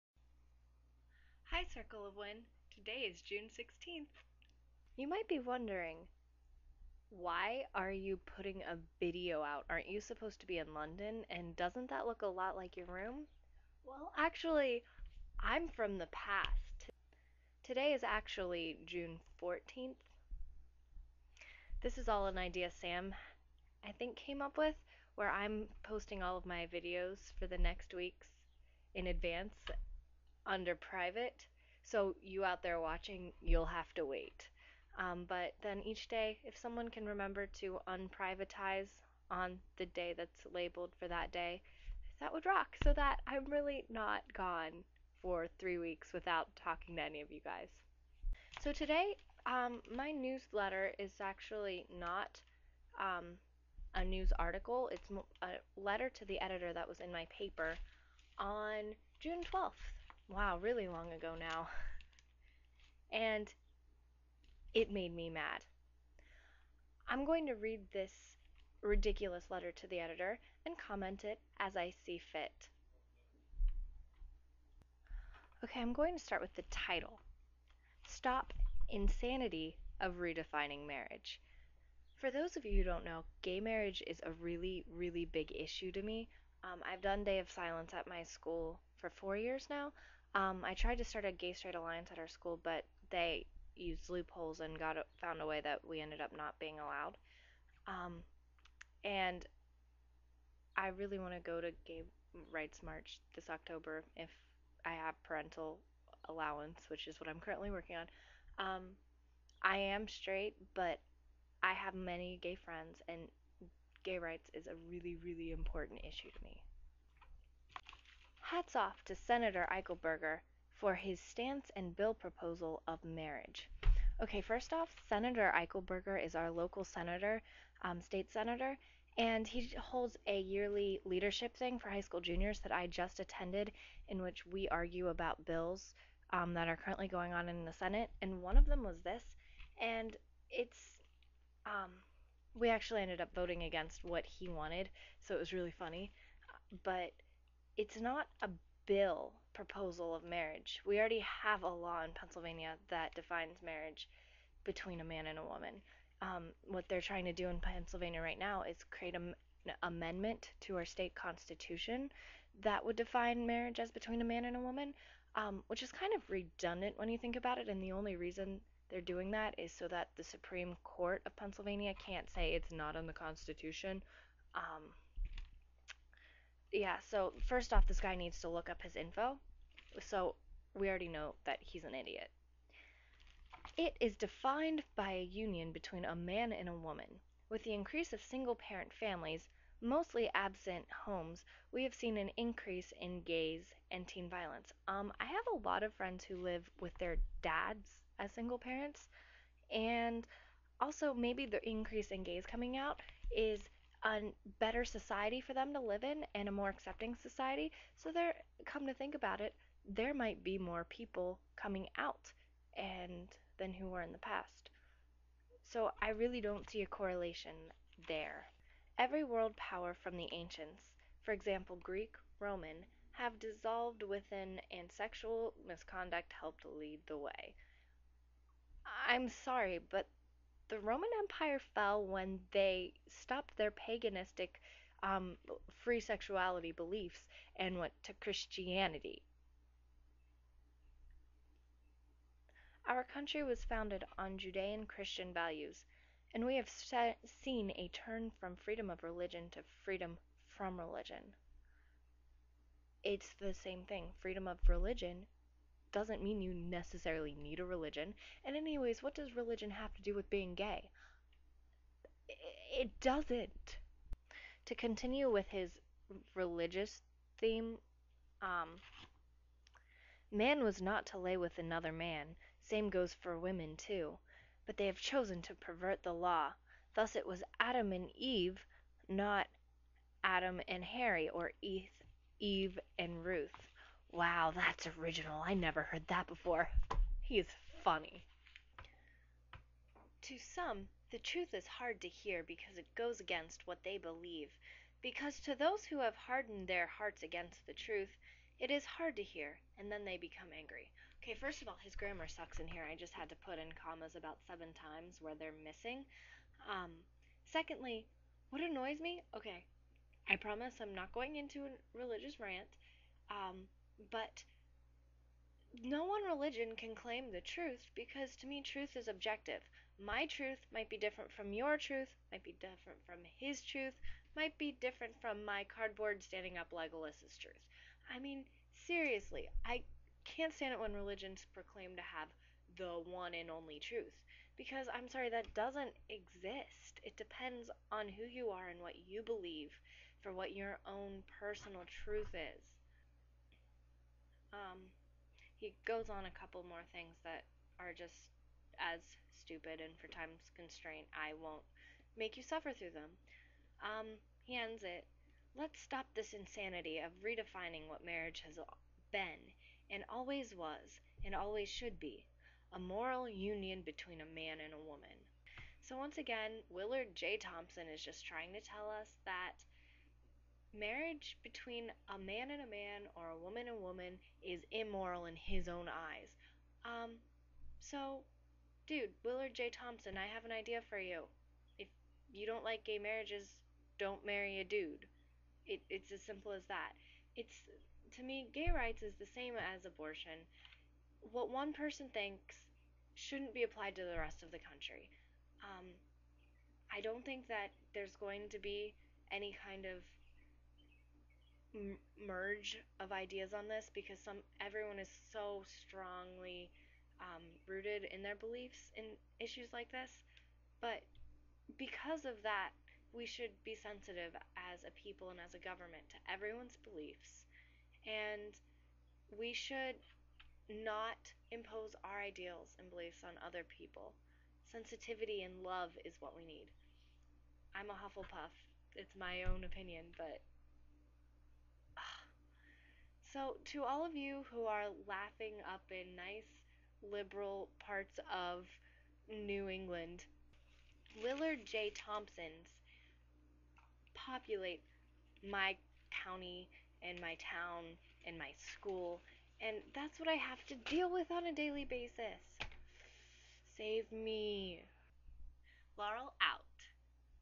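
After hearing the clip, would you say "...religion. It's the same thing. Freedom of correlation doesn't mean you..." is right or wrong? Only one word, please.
wrong.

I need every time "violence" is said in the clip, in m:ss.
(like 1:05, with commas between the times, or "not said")
3:14.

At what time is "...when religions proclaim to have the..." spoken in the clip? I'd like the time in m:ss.
5:30.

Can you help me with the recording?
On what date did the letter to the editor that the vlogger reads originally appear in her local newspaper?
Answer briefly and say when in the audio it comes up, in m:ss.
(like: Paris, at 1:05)
June 12th, at 0:59.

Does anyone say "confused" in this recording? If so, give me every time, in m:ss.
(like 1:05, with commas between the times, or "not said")
not said.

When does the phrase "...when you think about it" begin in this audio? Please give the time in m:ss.
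2:46.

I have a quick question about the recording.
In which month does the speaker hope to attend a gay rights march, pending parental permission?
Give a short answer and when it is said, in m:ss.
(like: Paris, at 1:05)
October, at 1:43.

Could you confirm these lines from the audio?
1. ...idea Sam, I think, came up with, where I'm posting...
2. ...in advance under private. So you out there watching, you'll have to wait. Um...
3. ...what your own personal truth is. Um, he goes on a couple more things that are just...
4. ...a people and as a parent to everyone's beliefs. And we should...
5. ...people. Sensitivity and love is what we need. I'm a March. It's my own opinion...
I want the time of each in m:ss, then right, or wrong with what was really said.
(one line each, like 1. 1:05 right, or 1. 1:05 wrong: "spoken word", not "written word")
1. 0:22 right
2. 0:28 right
3. 5:40 right
4. 6:54 wrong: "government", not "parent"
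5. 7:03 wrong: "Hufflepuff", not "March".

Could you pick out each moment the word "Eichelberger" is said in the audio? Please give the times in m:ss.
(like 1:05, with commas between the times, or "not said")
1:59, 2:05.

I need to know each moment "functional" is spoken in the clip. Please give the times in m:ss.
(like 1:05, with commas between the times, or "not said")
not said.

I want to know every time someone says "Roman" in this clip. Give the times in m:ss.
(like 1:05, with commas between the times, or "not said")
3:42, 3:50.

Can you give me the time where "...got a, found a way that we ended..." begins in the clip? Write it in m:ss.
1:34.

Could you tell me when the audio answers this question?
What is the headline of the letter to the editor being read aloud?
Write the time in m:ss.
1:18.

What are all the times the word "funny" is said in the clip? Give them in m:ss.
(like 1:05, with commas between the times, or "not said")
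2:25, 4:47.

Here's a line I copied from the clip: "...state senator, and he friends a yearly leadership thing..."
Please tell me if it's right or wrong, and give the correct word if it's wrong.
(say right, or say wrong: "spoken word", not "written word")
wrong: "holds", not "friends".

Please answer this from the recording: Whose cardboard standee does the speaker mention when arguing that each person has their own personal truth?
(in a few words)
Legolas.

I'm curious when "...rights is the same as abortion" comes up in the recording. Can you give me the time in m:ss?
6:28.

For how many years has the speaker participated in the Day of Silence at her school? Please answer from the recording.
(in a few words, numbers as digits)
4 years.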